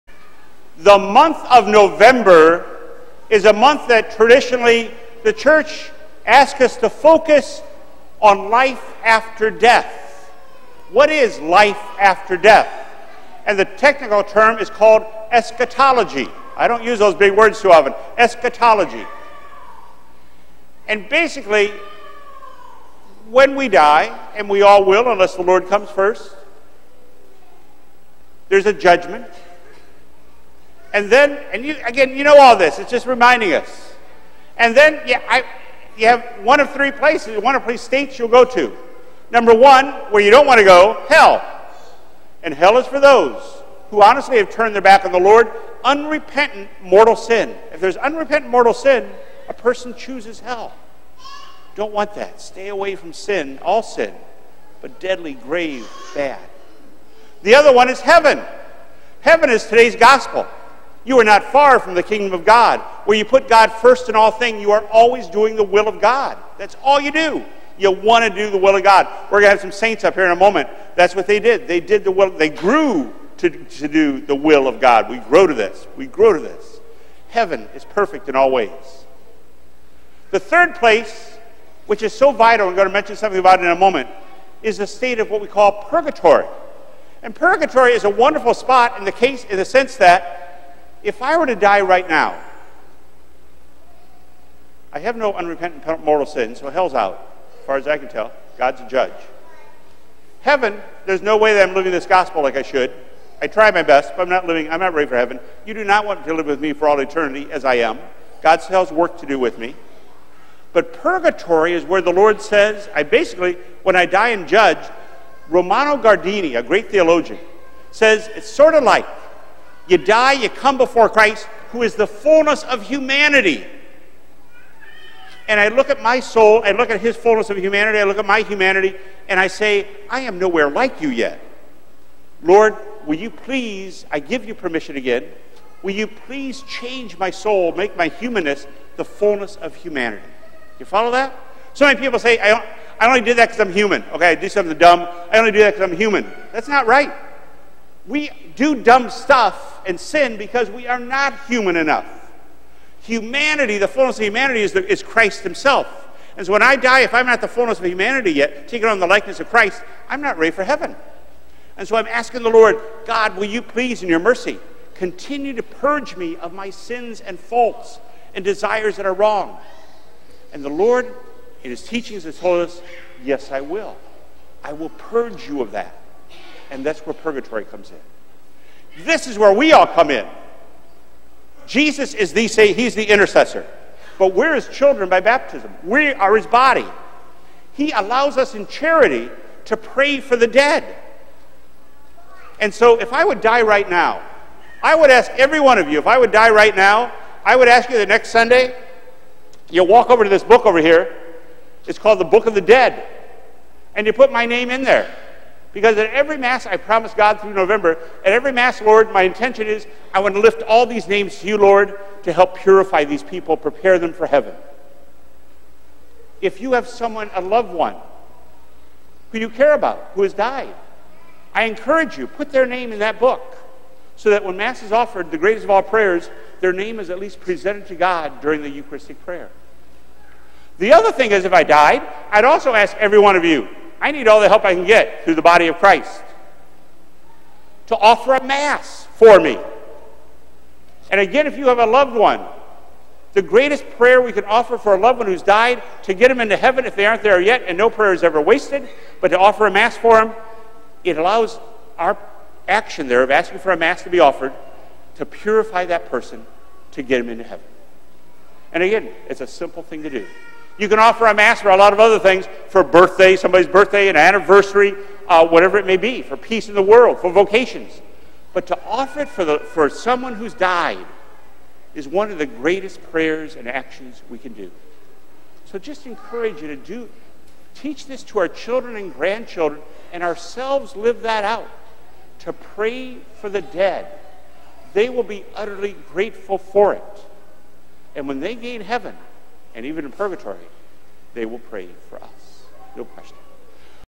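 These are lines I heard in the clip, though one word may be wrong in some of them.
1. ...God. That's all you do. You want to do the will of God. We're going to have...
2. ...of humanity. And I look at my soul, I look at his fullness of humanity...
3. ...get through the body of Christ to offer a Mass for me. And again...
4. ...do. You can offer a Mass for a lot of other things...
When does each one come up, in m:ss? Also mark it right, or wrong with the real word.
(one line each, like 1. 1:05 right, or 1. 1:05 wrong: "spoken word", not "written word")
1. 1:05 right
2. 2:02 right
3. 3:54 right
4. 4:20 right.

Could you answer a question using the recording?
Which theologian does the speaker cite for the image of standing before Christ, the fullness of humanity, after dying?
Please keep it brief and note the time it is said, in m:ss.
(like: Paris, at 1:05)
Romano Guardini, at 1:55.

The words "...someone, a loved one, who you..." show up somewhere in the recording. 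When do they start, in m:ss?
3:36.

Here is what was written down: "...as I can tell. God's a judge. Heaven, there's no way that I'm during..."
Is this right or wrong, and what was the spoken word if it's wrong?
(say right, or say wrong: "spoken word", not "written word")
wrong: "living", not "during".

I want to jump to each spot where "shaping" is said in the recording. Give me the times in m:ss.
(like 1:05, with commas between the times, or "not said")
not said.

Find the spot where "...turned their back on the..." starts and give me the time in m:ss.
0:44.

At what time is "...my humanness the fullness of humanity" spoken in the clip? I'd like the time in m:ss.
2:17.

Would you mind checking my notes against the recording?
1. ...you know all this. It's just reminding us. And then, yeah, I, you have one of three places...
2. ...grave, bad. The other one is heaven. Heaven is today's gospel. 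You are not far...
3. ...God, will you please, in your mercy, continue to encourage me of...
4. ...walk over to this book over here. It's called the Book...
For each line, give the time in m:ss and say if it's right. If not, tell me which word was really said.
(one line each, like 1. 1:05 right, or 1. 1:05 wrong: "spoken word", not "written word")
1. 0:32 right
2. 0:55 right
3. 2:43 wrong: "purge", not "encourage"
4. 3:19 right.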